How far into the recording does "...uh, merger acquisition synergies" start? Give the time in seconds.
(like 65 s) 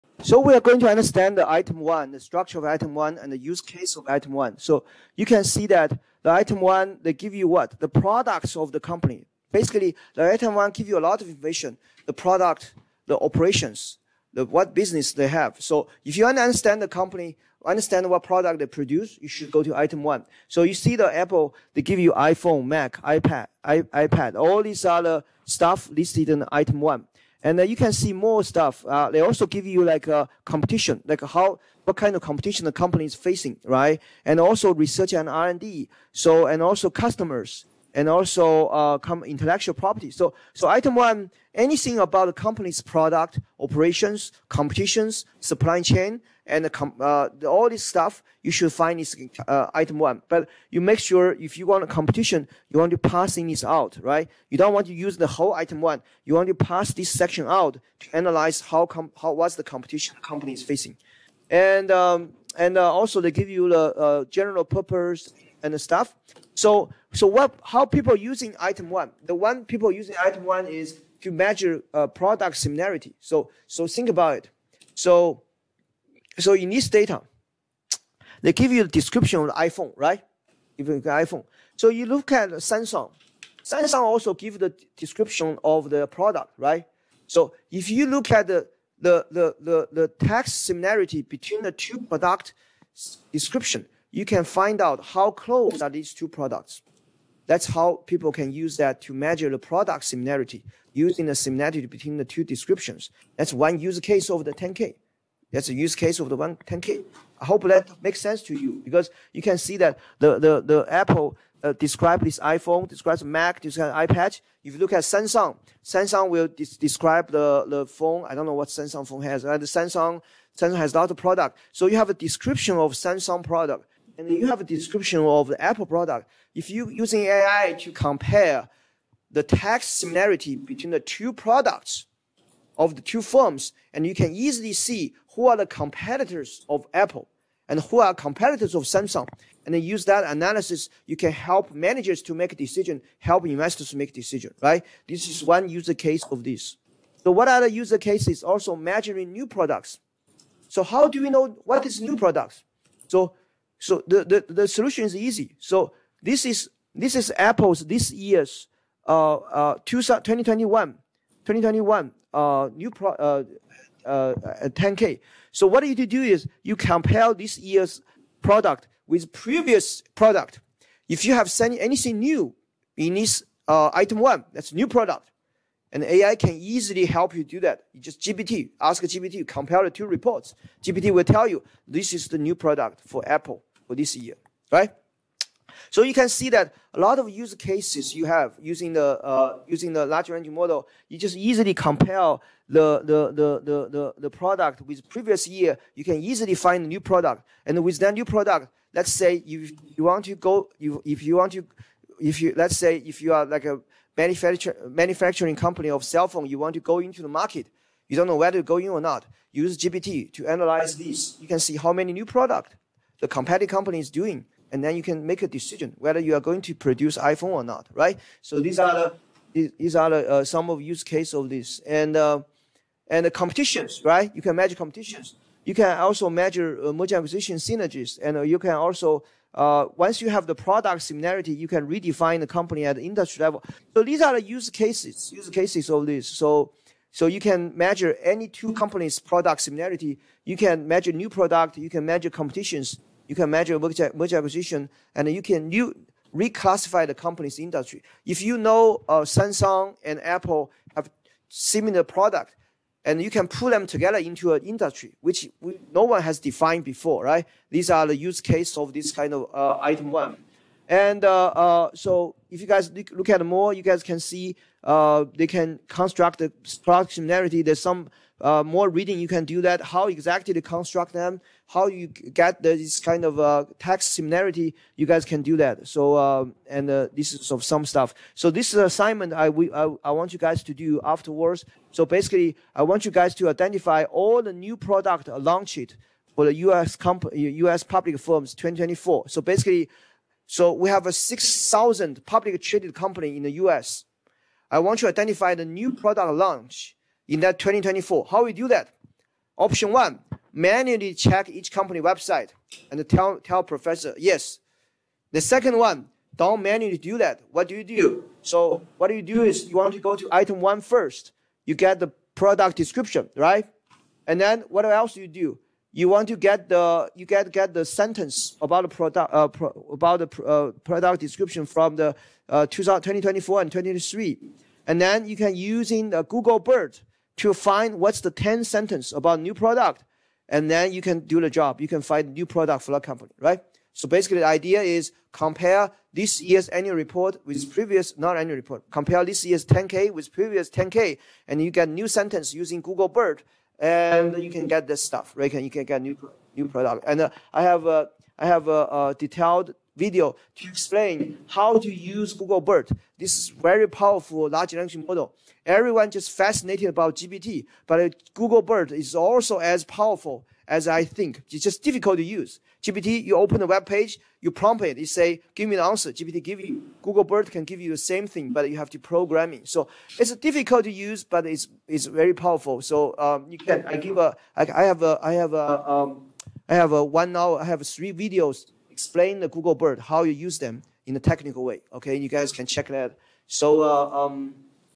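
226 s.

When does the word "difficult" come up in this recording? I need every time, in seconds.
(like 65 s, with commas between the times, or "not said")
361 s, 370 s.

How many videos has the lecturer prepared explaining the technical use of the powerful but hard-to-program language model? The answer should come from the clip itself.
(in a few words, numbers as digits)
3.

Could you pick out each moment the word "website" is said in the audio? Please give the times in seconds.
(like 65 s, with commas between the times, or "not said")
302 s.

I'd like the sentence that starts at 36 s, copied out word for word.
So and also customers and also uh, intellectual property.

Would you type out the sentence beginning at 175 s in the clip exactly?
And AI can easily help you do that.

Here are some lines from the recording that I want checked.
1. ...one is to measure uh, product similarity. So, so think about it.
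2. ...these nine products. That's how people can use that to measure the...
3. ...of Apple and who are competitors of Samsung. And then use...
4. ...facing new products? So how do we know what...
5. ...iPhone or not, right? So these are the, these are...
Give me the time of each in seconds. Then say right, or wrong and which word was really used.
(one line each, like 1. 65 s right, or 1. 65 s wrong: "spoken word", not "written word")
1. 70 s right
2. 95 s wrong: "two", not "nine"
3. 136 s right
4. 148 s wrong: "measuring", not "facing"
5. 217 s right.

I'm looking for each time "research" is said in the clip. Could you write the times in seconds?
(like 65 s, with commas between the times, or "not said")
34 s.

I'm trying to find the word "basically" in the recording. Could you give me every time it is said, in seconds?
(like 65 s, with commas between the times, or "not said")
9 s, 282 s, 289 s, 334 s.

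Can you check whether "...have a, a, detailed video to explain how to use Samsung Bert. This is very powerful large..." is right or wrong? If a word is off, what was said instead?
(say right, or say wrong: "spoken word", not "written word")
wrong: "Google", not "Samsung".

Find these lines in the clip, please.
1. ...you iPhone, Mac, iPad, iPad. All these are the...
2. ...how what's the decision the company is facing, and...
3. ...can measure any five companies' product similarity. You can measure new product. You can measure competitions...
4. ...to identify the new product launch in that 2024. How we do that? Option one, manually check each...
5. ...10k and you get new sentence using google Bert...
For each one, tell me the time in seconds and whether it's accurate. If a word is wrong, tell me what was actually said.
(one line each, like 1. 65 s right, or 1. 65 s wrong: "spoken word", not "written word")
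1. 21 s right
2. 59 s wrong: "competition", not "decision"
3. 237 s wrong: "two", not "five"
4. 294 s right
5. 340 s right.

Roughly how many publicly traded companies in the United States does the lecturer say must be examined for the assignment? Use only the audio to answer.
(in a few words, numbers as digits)
6,000.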